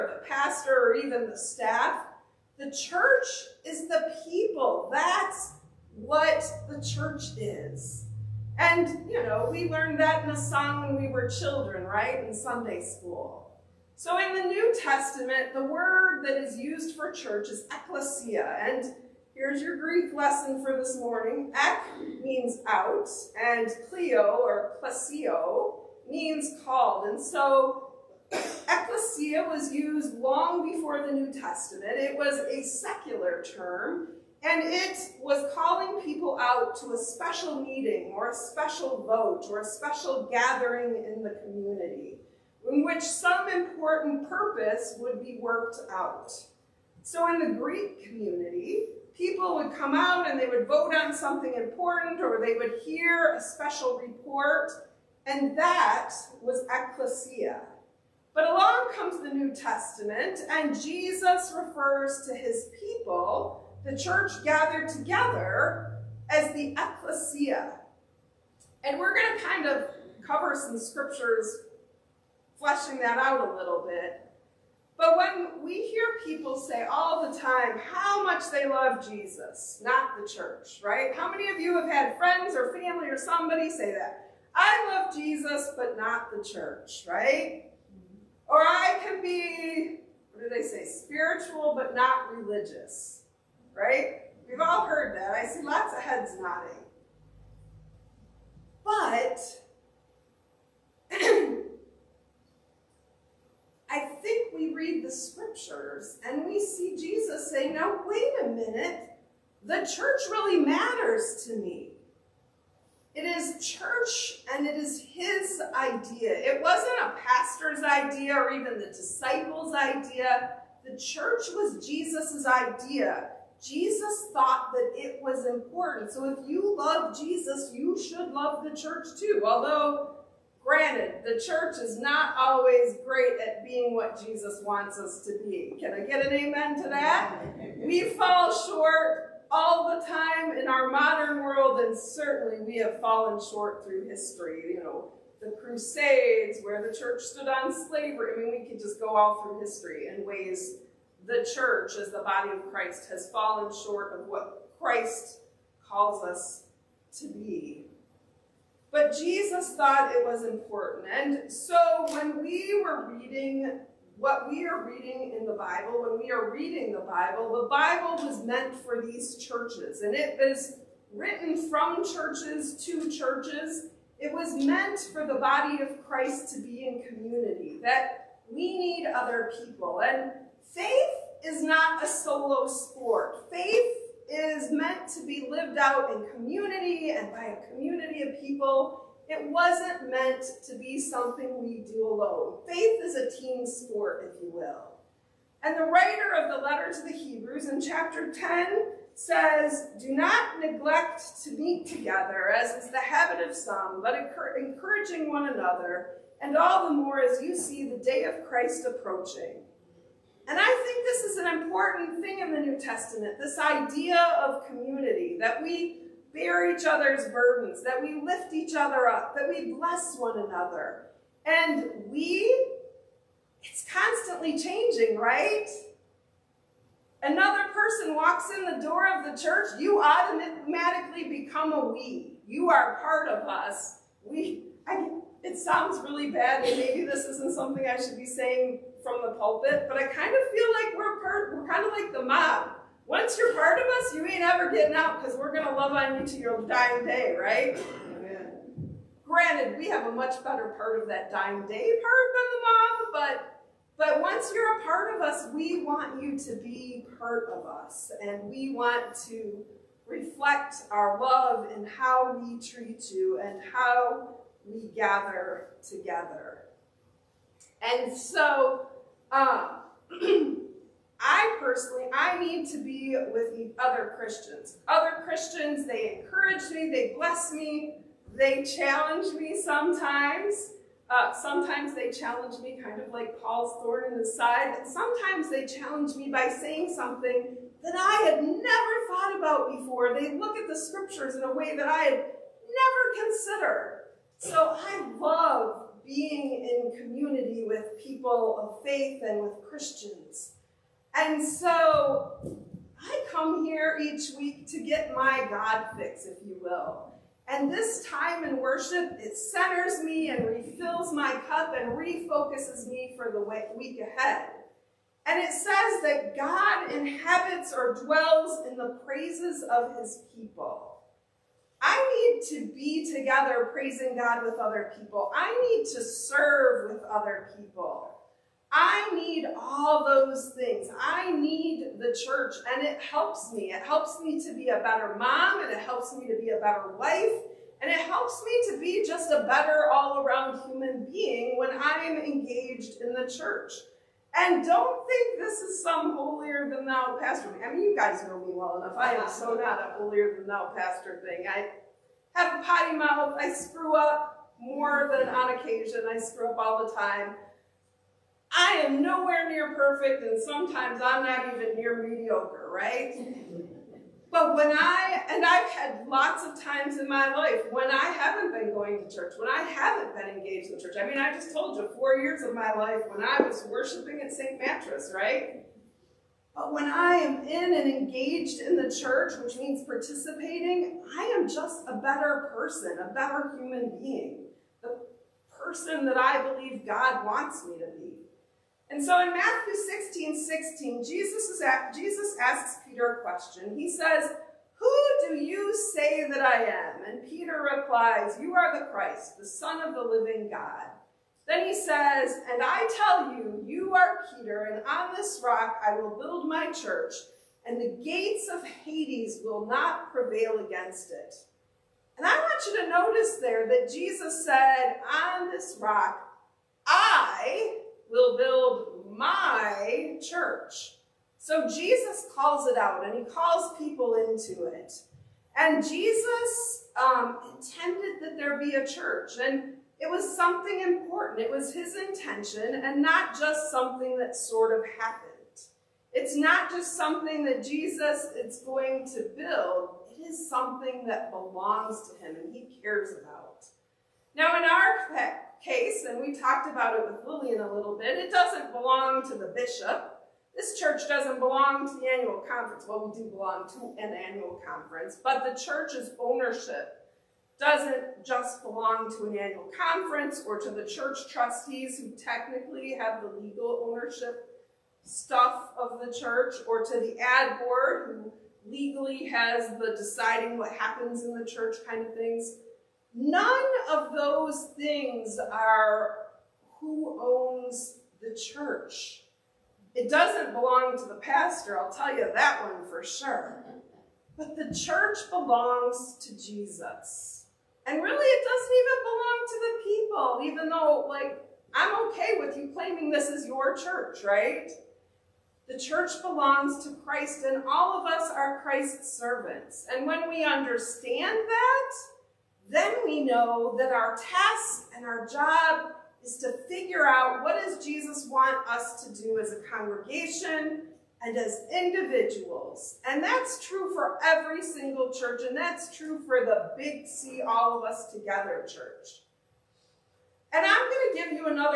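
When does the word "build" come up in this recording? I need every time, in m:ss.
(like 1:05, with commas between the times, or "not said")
6:46, 6:58, 7:19.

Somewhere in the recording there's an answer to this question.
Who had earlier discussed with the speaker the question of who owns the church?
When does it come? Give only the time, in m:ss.
7:27.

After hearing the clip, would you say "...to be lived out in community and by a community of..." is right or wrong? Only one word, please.
right.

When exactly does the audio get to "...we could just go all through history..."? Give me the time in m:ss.
2:28.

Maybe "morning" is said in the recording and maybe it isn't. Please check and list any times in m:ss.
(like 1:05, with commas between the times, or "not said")
0:20.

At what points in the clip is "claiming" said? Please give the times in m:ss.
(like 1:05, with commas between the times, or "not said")
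8:12.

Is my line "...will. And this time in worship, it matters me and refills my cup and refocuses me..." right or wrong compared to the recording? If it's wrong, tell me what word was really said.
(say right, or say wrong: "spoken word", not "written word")
wrong: "centers", not "matters".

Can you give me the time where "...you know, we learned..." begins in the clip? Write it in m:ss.
0:09.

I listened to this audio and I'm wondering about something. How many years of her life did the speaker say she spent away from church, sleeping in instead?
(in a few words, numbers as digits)
4.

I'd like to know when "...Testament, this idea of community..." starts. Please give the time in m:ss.
3:32.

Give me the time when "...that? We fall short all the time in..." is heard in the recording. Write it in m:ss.
2:16.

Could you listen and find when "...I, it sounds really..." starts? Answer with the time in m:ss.
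3:54.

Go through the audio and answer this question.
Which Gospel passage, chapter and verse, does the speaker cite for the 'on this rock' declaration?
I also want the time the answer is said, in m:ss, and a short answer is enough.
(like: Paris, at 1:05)
Matthew 16:16, at 6:29.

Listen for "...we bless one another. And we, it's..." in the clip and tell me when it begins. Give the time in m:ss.
3:39.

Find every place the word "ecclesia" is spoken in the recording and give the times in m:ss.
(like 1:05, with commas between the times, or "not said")
0:17, 0:28, 0:56, 1:06.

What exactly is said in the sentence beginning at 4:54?
So I love being in community with people of faith and with Christians.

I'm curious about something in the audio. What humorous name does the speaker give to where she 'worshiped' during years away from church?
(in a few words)
St. Mattress.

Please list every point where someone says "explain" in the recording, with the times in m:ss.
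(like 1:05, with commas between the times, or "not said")
not said.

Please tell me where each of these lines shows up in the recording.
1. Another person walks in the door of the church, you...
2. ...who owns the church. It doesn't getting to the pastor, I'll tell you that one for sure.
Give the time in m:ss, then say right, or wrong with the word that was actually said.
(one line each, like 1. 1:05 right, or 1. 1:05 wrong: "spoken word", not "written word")
1. 3:47 right
2. 7:56 wrong: "belong", not "getting".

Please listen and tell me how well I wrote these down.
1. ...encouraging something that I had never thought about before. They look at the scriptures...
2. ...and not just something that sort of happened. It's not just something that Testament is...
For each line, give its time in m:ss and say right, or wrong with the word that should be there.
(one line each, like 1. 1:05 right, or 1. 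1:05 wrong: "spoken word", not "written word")
1. 4:46 wrong: "saying", not "encouraging"
2. 7:12 wrong: "Jesus", not "Testament".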